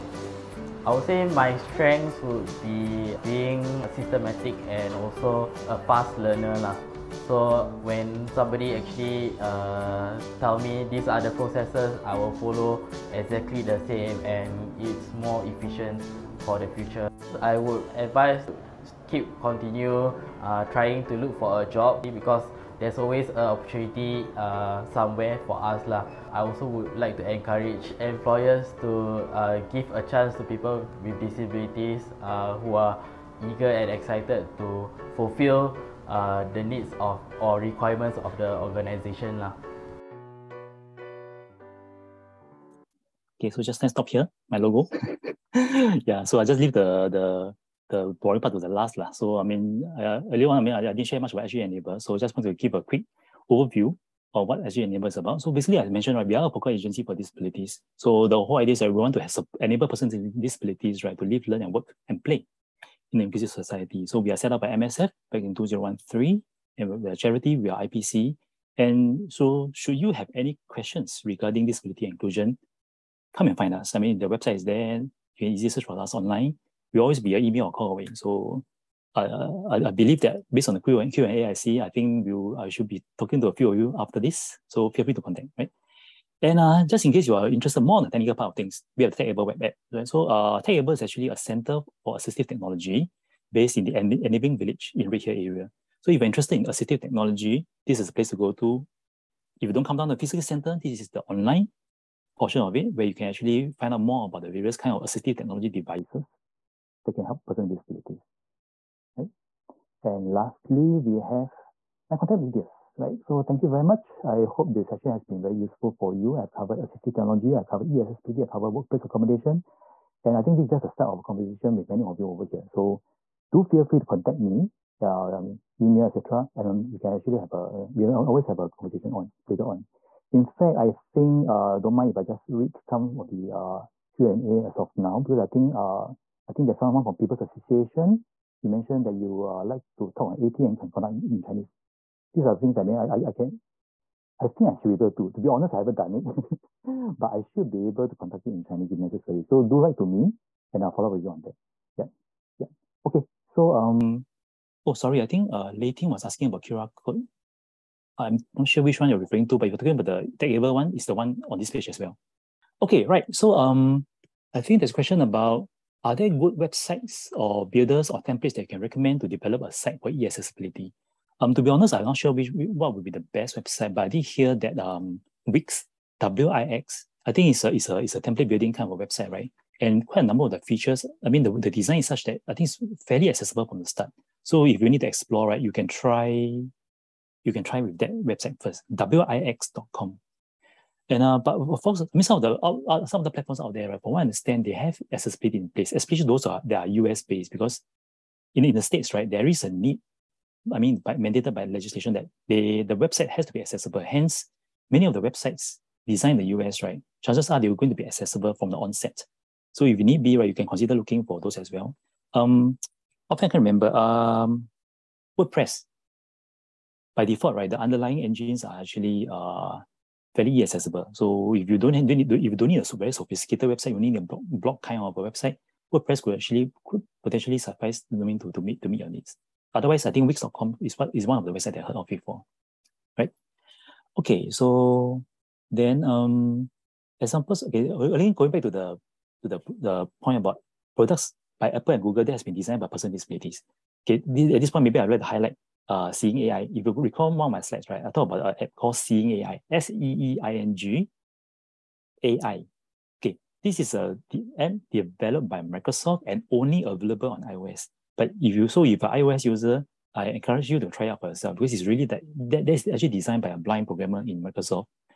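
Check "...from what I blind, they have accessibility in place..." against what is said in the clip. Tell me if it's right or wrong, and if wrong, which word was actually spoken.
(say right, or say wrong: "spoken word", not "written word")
wrong: "understand", not "blind".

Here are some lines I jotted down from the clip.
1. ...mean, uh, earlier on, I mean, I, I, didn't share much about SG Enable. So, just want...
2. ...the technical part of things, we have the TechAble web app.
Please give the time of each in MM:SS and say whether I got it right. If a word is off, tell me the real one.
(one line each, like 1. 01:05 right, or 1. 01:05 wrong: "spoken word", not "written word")
1. 00:49 right
2. 01:28 right.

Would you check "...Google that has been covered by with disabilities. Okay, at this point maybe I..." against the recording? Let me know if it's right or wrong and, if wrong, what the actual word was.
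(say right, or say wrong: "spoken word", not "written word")
wrong: "designed", not "covered".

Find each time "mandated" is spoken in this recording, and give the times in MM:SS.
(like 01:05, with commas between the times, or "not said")
03:21.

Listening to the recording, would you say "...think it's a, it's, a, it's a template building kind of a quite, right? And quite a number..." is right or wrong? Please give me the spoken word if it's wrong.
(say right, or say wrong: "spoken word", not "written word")
wrong: "website", not "quite".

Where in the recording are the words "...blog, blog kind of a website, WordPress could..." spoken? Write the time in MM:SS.
03:44.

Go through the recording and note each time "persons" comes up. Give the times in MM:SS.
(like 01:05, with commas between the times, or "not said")
00:59, 01:47.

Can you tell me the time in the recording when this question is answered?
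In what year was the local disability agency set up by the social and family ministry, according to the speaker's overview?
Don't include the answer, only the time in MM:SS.
01:05.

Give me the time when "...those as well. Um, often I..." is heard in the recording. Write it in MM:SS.
03:31.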